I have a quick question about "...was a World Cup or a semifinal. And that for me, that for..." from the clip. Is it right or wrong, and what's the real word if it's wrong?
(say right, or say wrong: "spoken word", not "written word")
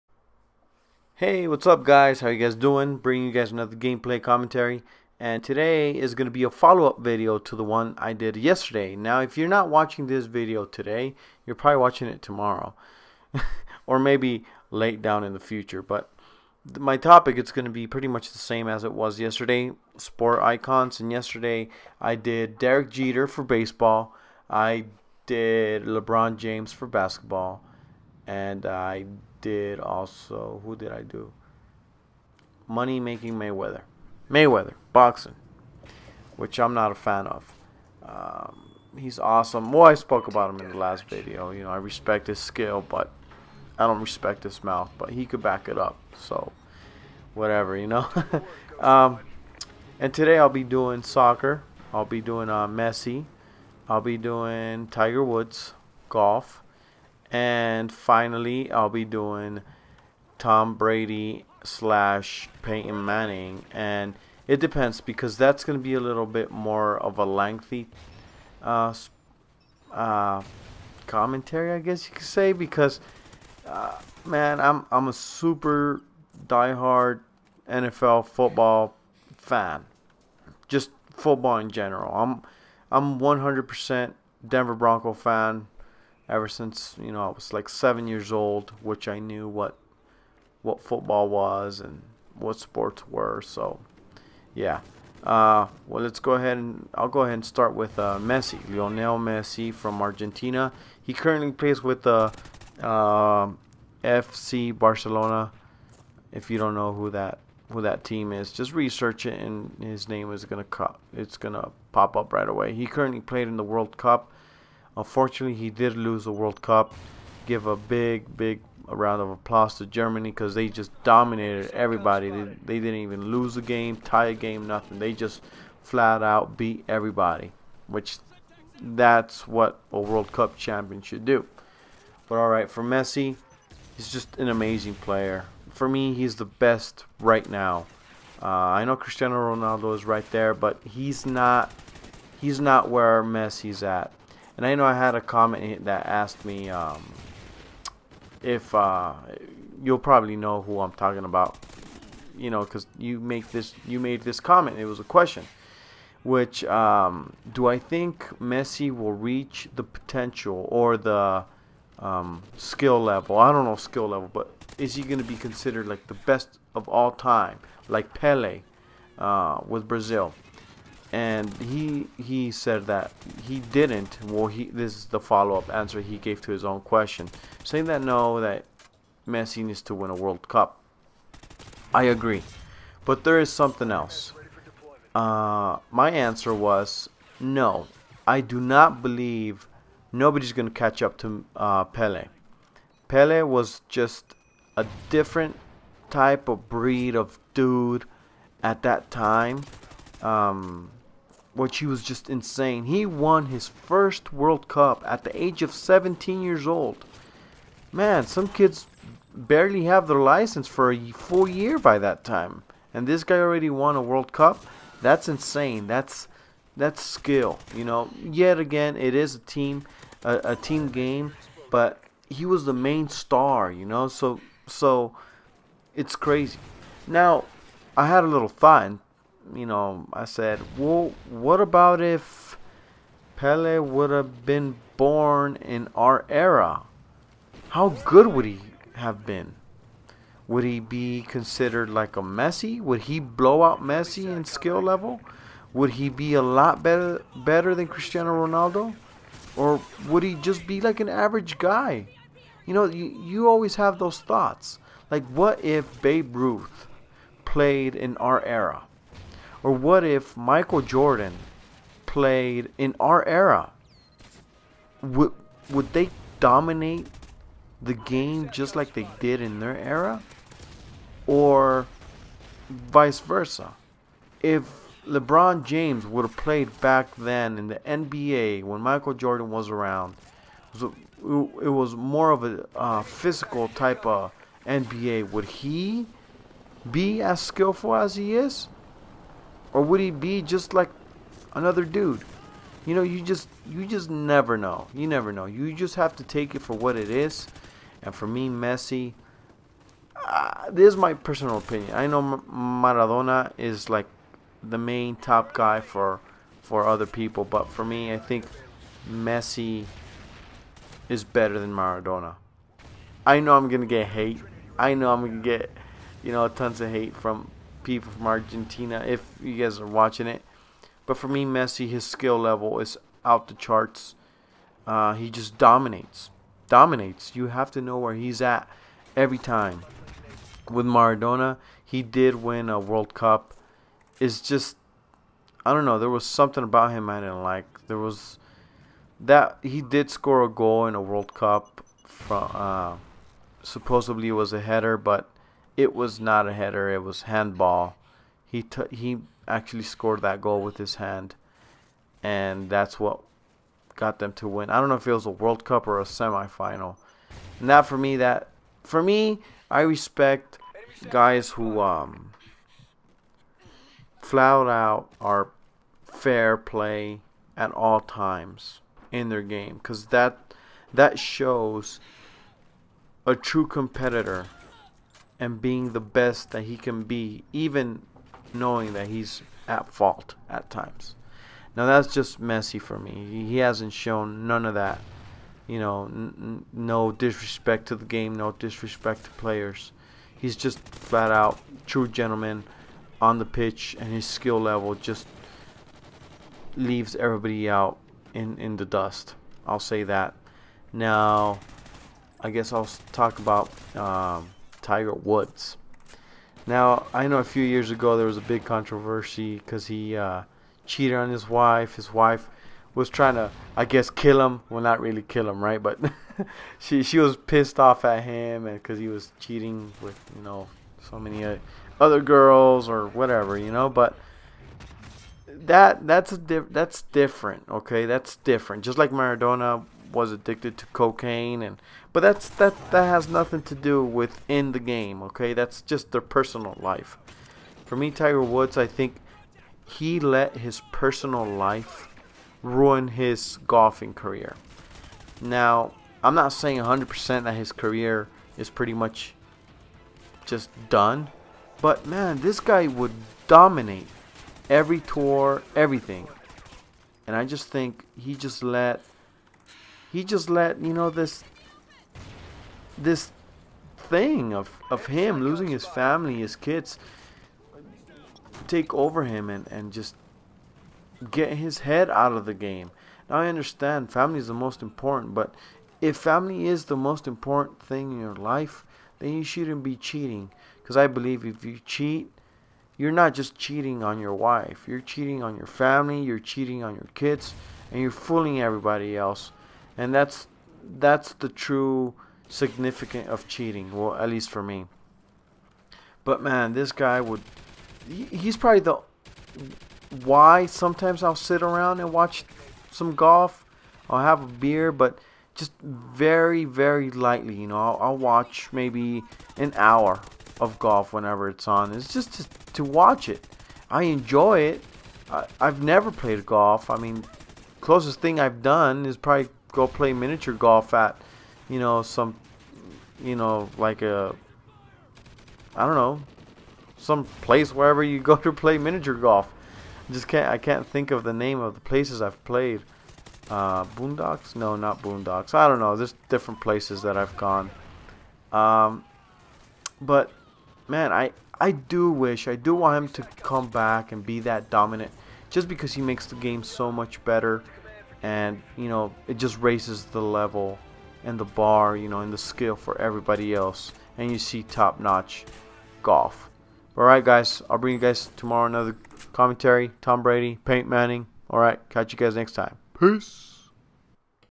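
right.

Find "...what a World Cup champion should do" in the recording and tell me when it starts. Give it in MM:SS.
02:09.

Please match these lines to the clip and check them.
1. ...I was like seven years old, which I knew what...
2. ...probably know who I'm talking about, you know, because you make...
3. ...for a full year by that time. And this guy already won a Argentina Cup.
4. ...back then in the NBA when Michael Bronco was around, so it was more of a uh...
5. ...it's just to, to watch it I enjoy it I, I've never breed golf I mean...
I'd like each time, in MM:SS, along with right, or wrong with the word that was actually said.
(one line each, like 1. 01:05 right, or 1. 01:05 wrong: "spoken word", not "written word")
1. 01:27 right
2. 02:29 right
3. 03:30 wrong: "World", not "Argentina"
4. 04:36 wrong: "Jordan", not "Bronco"
5. 08:31 wrong: "played", not "breed".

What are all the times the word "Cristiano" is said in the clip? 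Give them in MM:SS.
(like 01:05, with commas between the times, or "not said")
02:18, 04:07.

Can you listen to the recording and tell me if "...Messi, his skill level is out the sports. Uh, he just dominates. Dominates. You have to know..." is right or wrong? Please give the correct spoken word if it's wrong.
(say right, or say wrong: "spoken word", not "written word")
wrong: "charts", not "sports".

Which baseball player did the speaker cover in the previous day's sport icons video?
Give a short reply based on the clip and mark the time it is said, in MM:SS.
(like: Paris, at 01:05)
Derek Jeter, at 00:22.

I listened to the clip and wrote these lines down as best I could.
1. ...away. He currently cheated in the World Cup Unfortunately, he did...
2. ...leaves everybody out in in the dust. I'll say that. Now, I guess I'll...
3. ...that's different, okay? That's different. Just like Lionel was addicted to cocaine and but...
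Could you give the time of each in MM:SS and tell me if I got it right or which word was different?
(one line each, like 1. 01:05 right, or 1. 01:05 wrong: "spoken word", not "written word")
1. 01:52 wrong: "played", not "cheated"
2. 06:36 right
3. 07:06 wrong: "Maradona", not "Lionel".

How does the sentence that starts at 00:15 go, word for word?
But my topic it's going to be pretty much the same as it was yesterday.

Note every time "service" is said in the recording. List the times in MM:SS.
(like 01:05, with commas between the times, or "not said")
not said.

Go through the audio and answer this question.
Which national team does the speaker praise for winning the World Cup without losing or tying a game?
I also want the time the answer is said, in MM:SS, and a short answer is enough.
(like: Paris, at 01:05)
Germany, at 01:59.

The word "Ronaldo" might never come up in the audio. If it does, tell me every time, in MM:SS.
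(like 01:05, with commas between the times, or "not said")
02:19, 04:08.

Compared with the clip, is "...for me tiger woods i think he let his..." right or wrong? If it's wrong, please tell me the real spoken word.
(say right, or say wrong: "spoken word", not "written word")
right.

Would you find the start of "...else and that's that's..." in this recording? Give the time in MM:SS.
08:09.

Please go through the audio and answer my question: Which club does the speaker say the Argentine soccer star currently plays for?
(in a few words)
FC Barcelona.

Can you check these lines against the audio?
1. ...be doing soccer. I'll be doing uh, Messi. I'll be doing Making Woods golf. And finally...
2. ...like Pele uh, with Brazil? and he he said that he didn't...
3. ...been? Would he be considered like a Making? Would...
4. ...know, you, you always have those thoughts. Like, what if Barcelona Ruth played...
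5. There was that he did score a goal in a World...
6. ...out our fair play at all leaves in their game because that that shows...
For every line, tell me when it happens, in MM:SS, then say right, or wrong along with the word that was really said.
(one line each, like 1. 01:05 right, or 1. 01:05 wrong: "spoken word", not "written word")
1. 00:50 wrong: "Tiger", not "Making"
2. 02:47 right
3. 03:59 wrong: "Messi", not "Making"
4. 04:12 wrong: "Babe", not "Barcelona"
5. 05:37 right
6. 06:04 wrong: "times", not "leaves".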